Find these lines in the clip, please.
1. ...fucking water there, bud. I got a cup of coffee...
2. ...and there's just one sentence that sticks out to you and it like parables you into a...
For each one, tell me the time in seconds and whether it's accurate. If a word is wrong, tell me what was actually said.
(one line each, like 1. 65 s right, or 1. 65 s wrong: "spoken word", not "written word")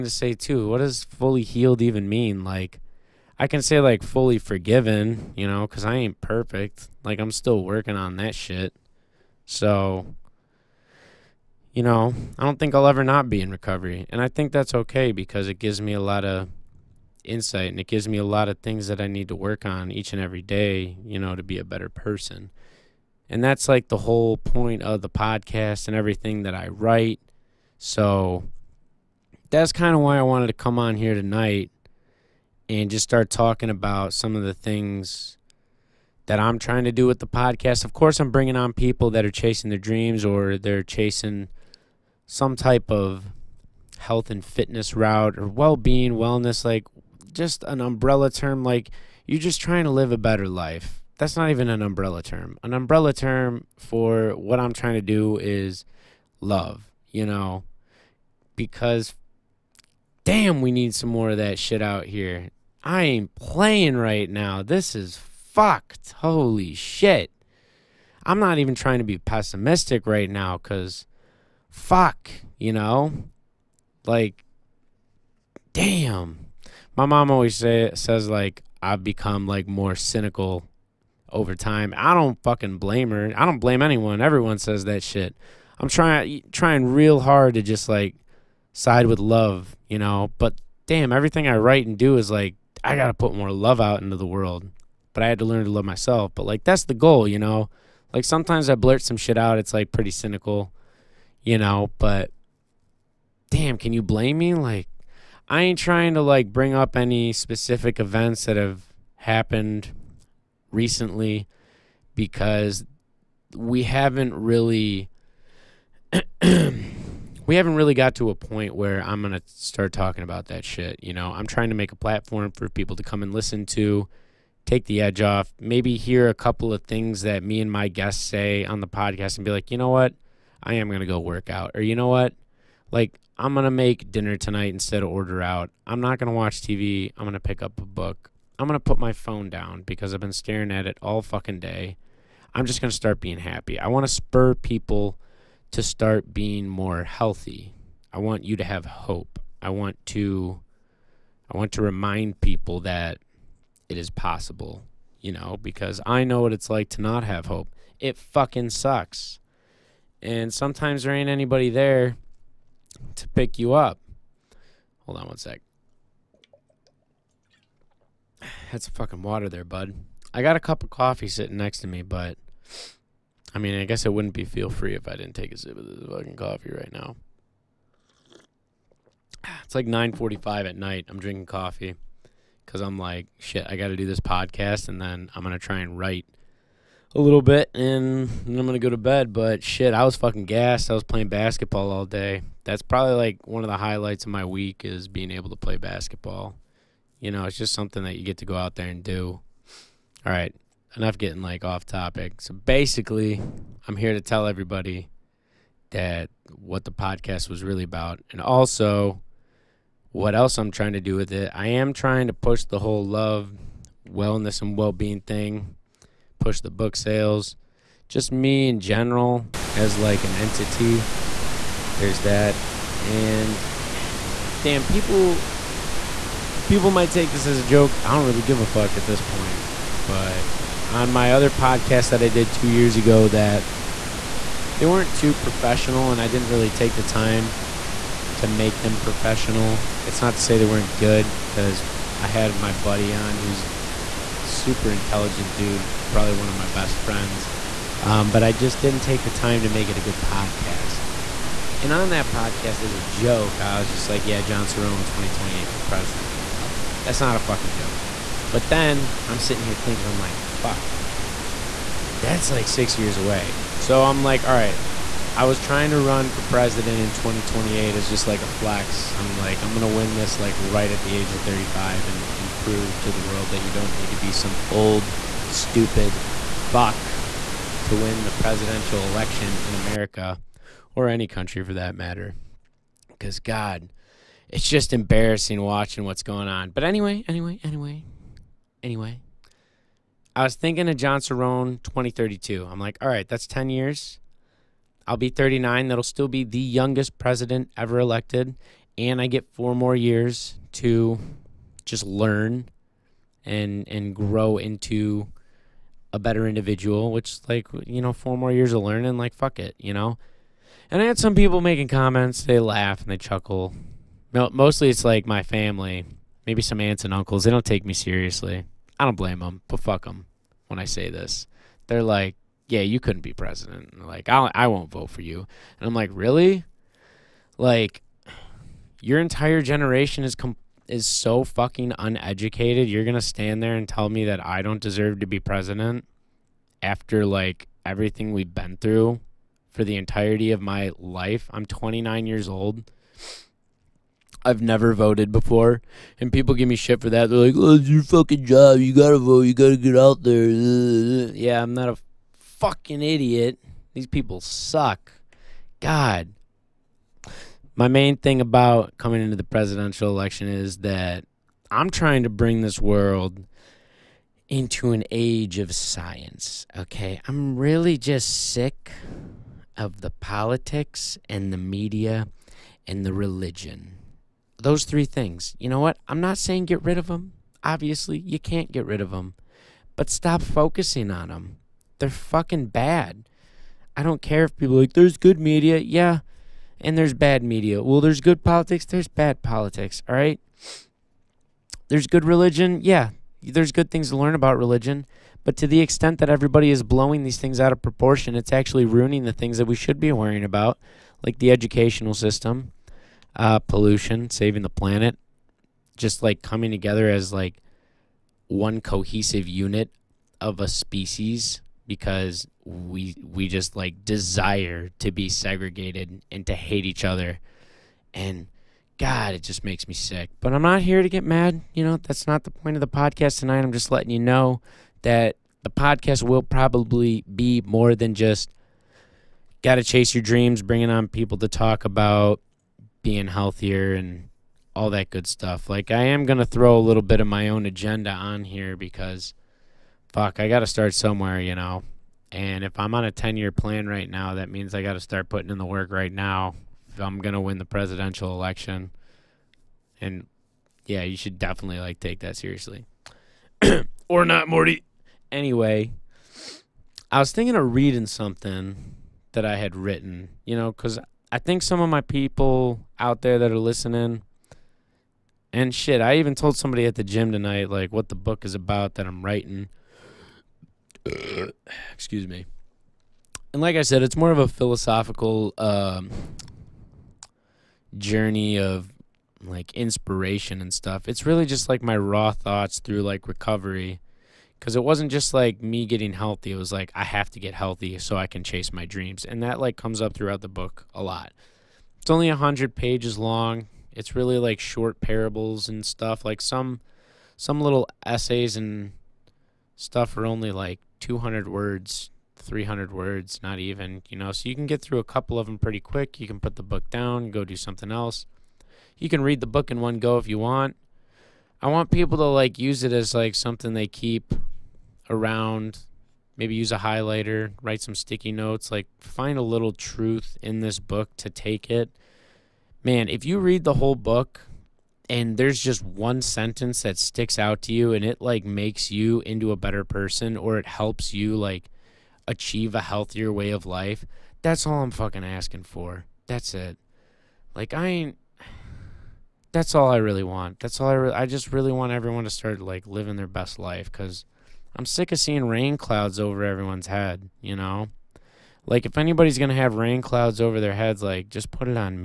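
1. 168 s right
2. 525 s wrong: "makes", not "parables".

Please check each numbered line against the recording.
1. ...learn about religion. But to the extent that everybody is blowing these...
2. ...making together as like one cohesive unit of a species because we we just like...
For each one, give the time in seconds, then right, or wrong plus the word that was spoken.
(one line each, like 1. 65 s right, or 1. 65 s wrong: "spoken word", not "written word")
1. 394 s right
2. 406 s wrong: "coming", not "making".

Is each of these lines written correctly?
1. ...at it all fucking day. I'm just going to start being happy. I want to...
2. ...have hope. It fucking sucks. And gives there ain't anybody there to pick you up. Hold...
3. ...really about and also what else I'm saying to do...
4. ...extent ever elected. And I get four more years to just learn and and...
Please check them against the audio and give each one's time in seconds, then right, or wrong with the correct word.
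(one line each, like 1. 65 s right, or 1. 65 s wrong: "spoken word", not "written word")
1. 140 s right
2. 157 s wrong: "sometimes", not "gives"
3. 207 s wrong: "trying", not "saying"
4. 297 s wrong: "president", not "extent".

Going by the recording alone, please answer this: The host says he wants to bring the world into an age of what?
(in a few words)
science.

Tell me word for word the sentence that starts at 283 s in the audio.
Because, God, it's just embarrassing watching what's going on.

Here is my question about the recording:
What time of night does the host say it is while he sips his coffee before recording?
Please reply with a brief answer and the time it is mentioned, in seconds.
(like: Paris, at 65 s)
9:45, at 179 s.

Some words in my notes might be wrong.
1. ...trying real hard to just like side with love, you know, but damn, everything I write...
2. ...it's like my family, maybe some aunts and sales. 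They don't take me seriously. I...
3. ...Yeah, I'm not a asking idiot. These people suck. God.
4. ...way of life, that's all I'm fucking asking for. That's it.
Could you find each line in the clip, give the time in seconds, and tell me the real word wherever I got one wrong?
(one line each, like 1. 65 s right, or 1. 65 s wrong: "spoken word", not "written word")
1. 86 s right
2. 314 s wrong: "uncles", not "sales"
3. 351 s wrong: "fucking", not "asking"
4. 533 s right.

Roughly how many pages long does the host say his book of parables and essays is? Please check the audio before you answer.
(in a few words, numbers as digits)
100.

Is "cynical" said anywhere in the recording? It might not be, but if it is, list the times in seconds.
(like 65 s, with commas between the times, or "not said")
79 s, 100 s.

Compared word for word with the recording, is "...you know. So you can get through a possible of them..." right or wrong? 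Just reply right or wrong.
wrong.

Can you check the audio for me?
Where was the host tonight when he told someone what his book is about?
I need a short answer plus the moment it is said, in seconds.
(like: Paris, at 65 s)
the gym, at 466 s.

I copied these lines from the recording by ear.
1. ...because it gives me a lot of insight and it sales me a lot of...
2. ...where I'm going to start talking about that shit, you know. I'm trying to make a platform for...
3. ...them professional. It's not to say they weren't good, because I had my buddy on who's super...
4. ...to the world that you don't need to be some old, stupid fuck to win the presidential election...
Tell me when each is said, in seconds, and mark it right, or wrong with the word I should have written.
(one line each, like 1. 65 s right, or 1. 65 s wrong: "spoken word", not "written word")
1. 15 s wrong: "gives", not "sales"
2. 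118 s right
3. 238 s right
4. 273 s right.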